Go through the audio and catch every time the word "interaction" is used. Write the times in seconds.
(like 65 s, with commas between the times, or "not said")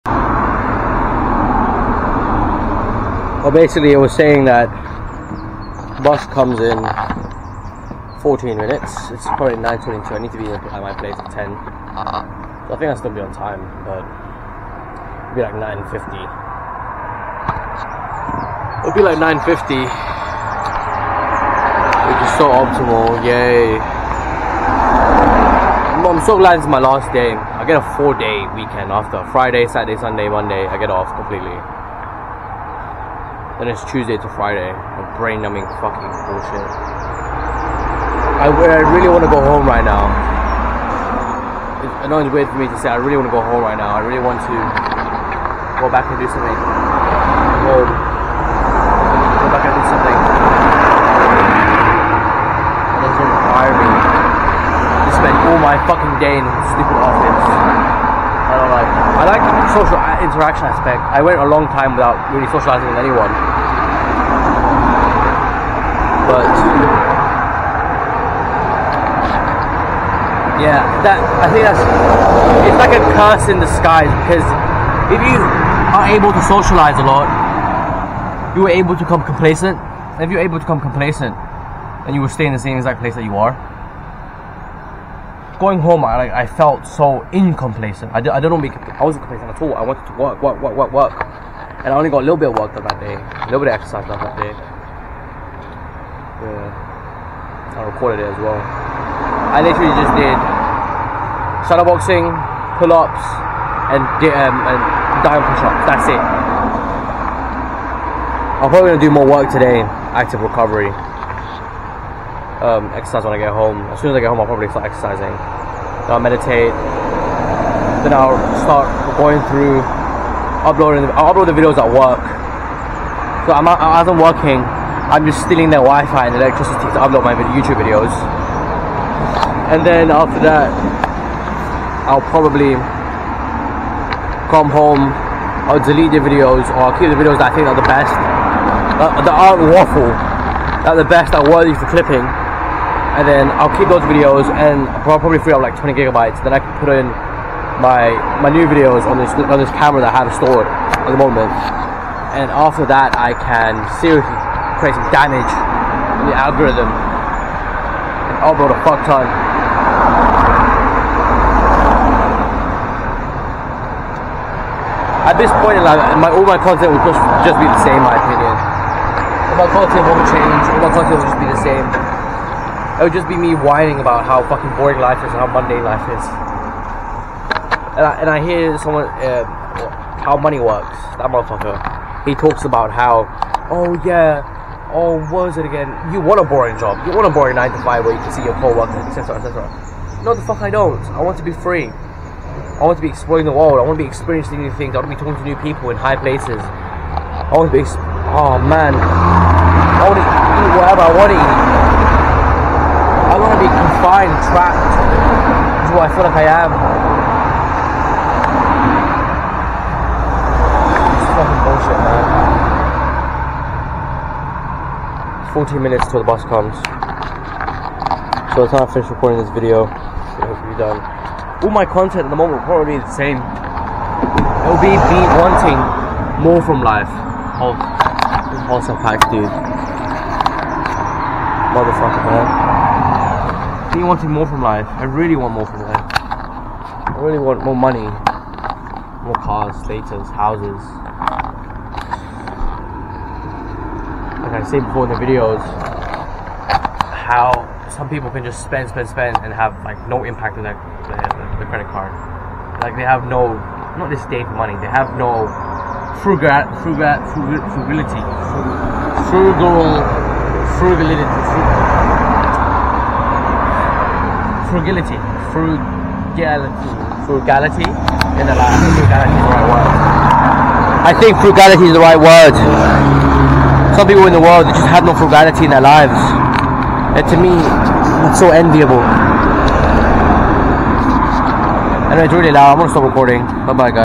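60 s.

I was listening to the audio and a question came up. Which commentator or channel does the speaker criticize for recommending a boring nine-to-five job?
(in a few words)
How Money Works.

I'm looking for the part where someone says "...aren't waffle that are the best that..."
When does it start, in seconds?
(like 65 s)
139 s.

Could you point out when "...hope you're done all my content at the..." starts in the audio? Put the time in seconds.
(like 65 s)
220 s.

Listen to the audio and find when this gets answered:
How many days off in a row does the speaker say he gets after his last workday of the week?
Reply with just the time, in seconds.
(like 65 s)
27 s.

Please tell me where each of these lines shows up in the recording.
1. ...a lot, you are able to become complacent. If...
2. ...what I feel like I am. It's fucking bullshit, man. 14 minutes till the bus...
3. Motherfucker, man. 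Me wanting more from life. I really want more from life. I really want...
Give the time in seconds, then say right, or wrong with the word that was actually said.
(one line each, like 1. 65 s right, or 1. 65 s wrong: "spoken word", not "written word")
1. 77 s right
2. 205 s right
3. 231 s right.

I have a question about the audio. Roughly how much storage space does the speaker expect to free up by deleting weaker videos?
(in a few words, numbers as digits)
20 gigabytes.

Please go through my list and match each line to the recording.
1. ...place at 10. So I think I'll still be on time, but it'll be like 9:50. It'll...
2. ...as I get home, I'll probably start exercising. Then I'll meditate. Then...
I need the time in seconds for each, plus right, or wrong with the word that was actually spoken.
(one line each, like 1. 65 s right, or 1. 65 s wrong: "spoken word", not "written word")
1. 10 s right
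2. 114 s right.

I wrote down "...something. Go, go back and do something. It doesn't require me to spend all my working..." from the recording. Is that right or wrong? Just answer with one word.
wrong.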